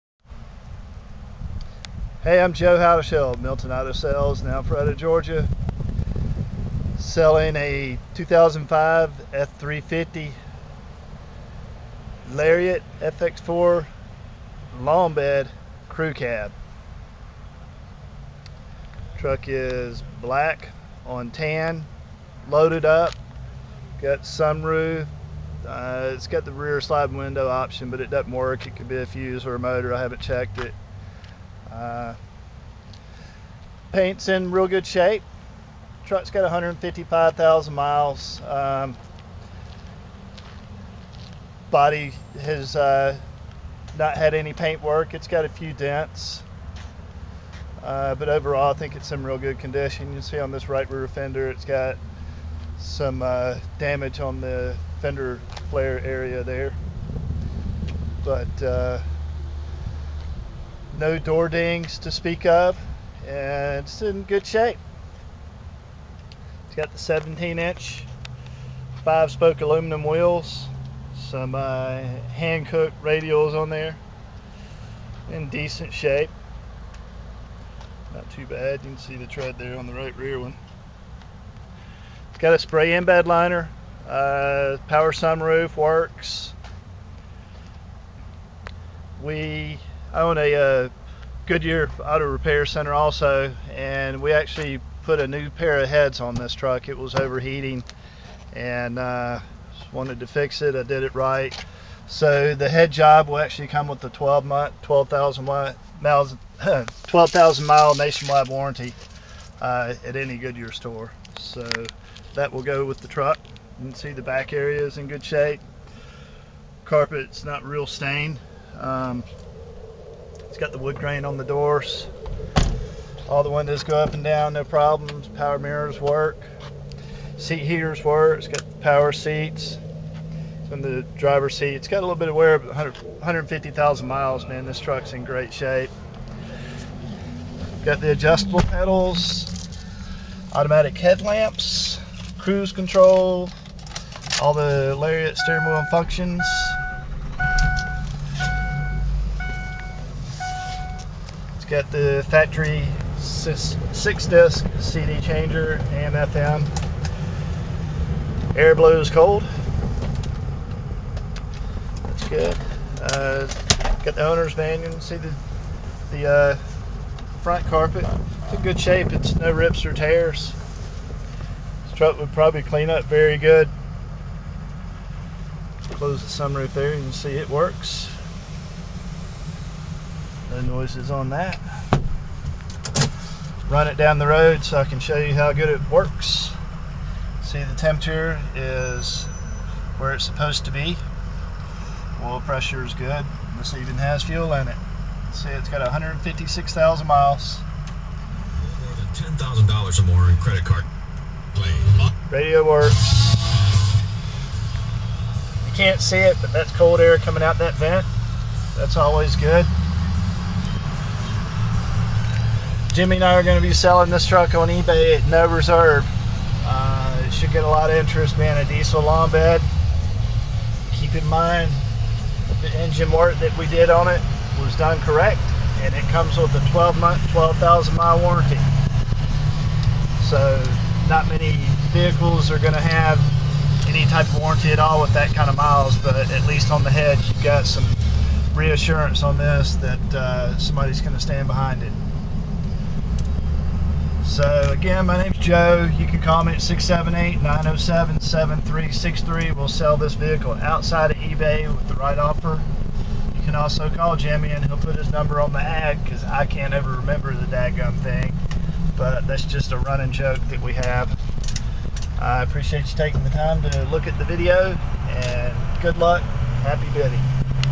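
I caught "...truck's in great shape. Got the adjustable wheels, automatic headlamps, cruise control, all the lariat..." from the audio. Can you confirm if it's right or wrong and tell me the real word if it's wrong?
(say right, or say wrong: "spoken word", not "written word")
wrong: "pedals", not "wheels".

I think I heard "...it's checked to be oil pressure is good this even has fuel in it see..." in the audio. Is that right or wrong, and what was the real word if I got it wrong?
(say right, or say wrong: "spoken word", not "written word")
wrong: "supposed", not "checked".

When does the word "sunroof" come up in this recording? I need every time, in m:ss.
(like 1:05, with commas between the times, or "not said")
0:24, 1:25, 2:56.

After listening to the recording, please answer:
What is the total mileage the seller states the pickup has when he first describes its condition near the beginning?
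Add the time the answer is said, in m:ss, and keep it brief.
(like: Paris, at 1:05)
155,000, at 0:36.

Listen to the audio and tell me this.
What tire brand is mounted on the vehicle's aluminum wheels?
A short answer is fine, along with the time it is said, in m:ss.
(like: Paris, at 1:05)
Hankook, at 1:12.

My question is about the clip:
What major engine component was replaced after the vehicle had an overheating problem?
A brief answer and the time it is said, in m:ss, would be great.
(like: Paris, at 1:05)
heads, at 1:35.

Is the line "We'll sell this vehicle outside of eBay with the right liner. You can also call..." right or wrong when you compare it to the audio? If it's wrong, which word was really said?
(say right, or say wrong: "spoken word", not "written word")
wrong: "offer", not "liner".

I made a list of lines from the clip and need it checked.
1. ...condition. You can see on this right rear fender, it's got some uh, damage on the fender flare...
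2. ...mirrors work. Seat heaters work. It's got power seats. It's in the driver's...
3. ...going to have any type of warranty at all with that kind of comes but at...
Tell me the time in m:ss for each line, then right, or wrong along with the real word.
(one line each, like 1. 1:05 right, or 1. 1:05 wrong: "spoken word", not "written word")
1. 0:49 right
2. 2:05 right
3. 3:52 wrong: "miles", not "comes".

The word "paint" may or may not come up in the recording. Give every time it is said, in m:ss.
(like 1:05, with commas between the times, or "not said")
0:33, 0:44.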